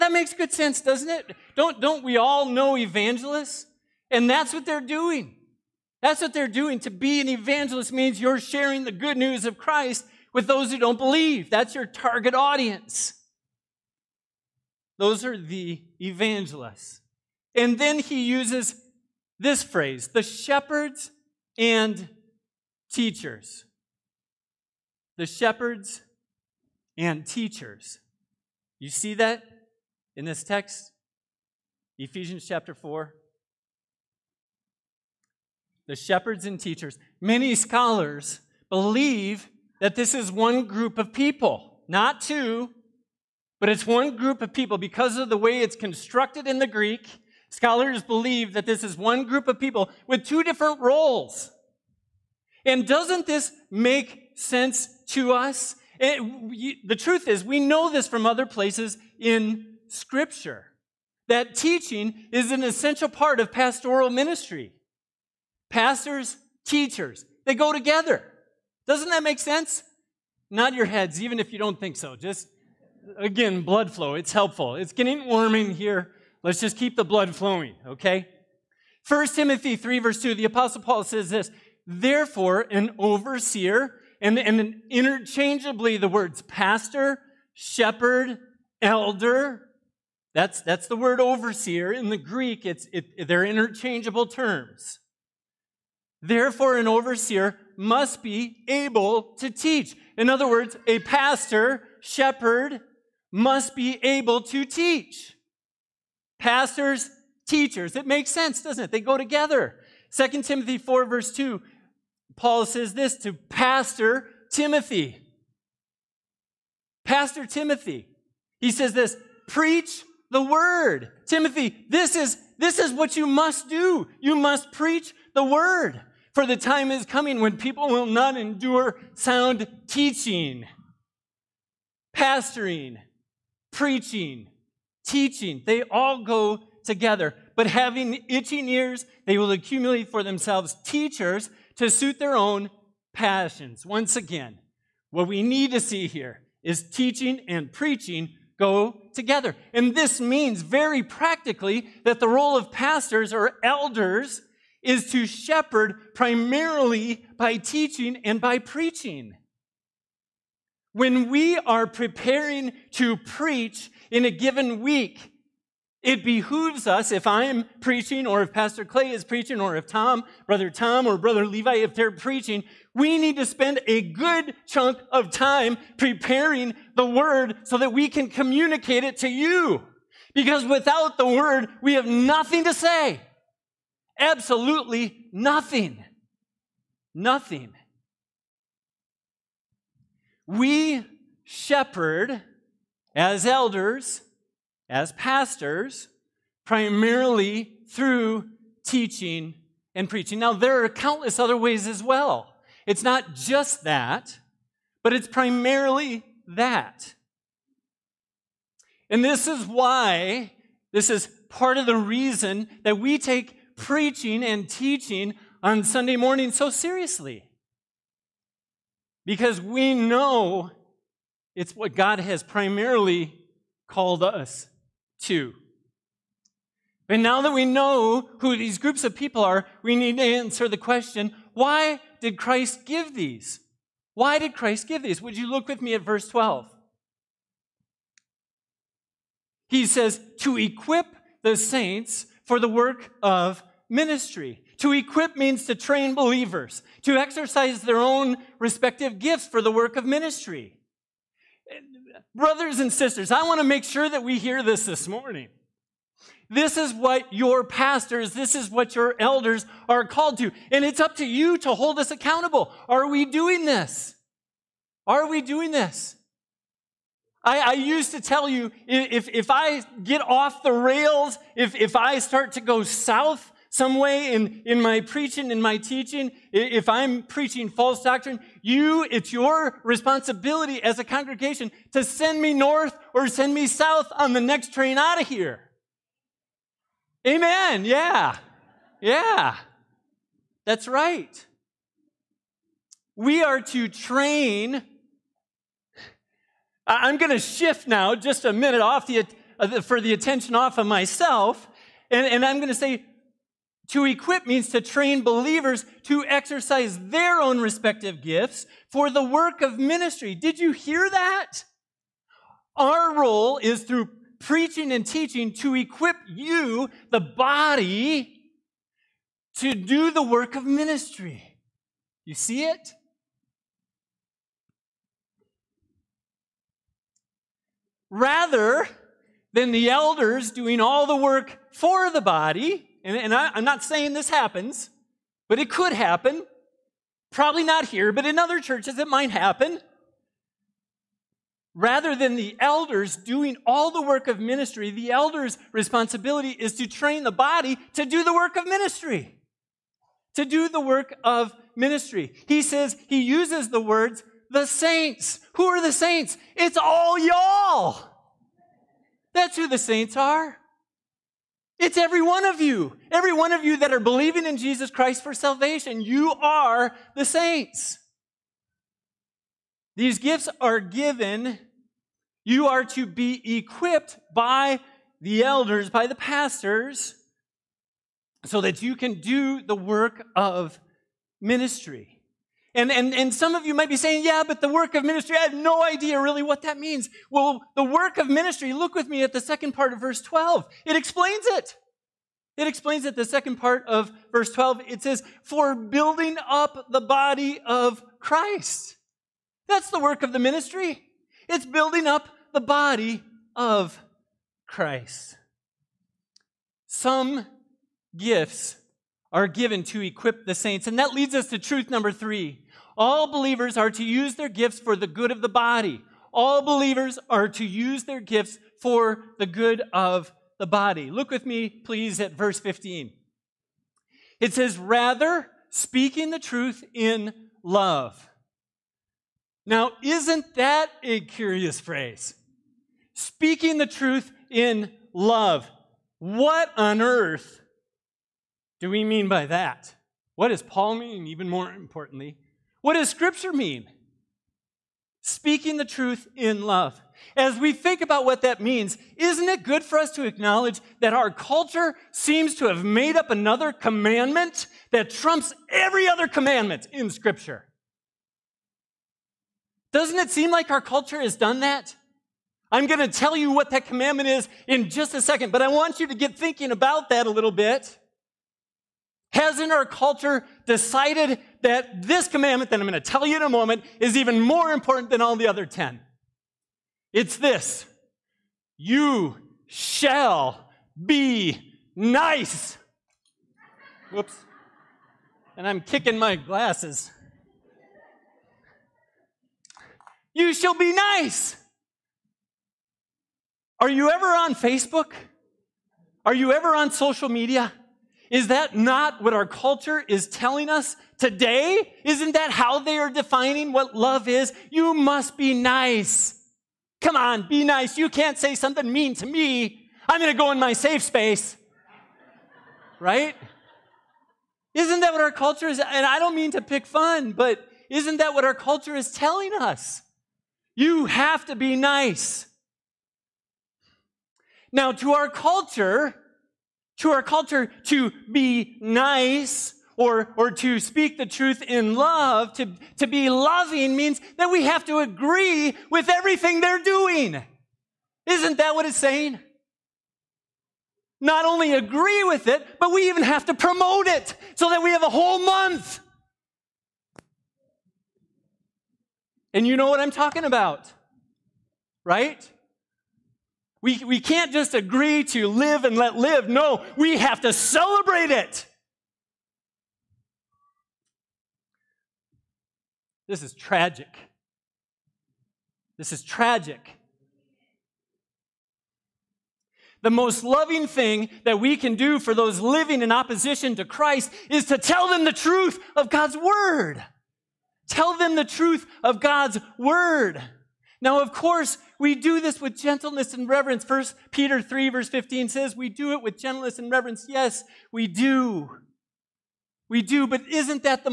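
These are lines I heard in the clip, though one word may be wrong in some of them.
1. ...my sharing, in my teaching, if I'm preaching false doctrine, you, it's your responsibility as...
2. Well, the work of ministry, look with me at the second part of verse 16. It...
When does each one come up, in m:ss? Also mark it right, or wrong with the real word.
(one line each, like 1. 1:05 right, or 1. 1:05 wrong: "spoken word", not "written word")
1. 4:34 wrong: "preaching", not "sharing"
2. 6:27 wrong: "12", not "16".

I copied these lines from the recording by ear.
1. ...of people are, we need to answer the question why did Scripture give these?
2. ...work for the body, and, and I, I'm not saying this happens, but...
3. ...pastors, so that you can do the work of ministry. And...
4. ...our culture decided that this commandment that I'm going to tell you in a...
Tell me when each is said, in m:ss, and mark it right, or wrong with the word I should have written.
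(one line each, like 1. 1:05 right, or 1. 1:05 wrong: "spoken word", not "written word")
1. 3:49 wrong: "Christ", not "Scripture"
2. 5:31 right
3. 6:16 right
4. 7:49 right.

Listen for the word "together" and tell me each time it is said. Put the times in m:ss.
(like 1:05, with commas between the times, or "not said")
1:07, 1:49, 2:16, 2:29.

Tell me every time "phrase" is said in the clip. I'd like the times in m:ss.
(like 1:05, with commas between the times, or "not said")
0:19, 7:11.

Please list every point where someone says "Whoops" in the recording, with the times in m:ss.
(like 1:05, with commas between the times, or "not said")
8:04.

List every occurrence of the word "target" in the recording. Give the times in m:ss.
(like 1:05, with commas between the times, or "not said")
0:11.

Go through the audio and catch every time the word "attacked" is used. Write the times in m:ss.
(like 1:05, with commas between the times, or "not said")
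not said.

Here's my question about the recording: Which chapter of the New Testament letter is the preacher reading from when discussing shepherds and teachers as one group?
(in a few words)
Ephesians chapter 4.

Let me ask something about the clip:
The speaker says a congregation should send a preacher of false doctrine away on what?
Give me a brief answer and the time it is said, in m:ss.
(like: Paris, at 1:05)
the next train, at 4:44.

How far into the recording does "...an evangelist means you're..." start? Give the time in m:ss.
0:07.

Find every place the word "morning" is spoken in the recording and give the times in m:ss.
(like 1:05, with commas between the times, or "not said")
3:36, 4:15.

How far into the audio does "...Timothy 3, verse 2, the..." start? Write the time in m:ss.
1:19.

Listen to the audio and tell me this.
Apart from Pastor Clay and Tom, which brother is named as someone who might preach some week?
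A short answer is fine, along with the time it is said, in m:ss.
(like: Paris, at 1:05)
Brother Levi, at 2:51.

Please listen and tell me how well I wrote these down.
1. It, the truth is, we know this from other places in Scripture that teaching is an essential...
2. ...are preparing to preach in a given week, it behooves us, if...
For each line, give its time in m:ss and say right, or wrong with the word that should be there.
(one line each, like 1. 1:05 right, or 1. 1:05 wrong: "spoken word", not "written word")
1. 0:56 right
2. 2:41 right.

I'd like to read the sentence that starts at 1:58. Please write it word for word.
He says this, preach the word.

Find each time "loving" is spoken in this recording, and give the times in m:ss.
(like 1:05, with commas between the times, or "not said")
8:53, 9:30.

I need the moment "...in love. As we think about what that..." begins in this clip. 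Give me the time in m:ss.
7:26.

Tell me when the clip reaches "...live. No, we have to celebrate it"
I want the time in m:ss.
9:16.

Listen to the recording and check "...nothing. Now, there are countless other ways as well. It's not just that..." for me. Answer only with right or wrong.
wrong.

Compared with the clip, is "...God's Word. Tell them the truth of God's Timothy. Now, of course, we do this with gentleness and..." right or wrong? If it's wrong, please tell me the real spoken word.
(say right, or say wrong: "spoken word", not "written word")
wrong: "Word", not "Timothy".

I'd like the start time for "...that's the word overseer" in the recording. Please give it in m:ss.
1:30.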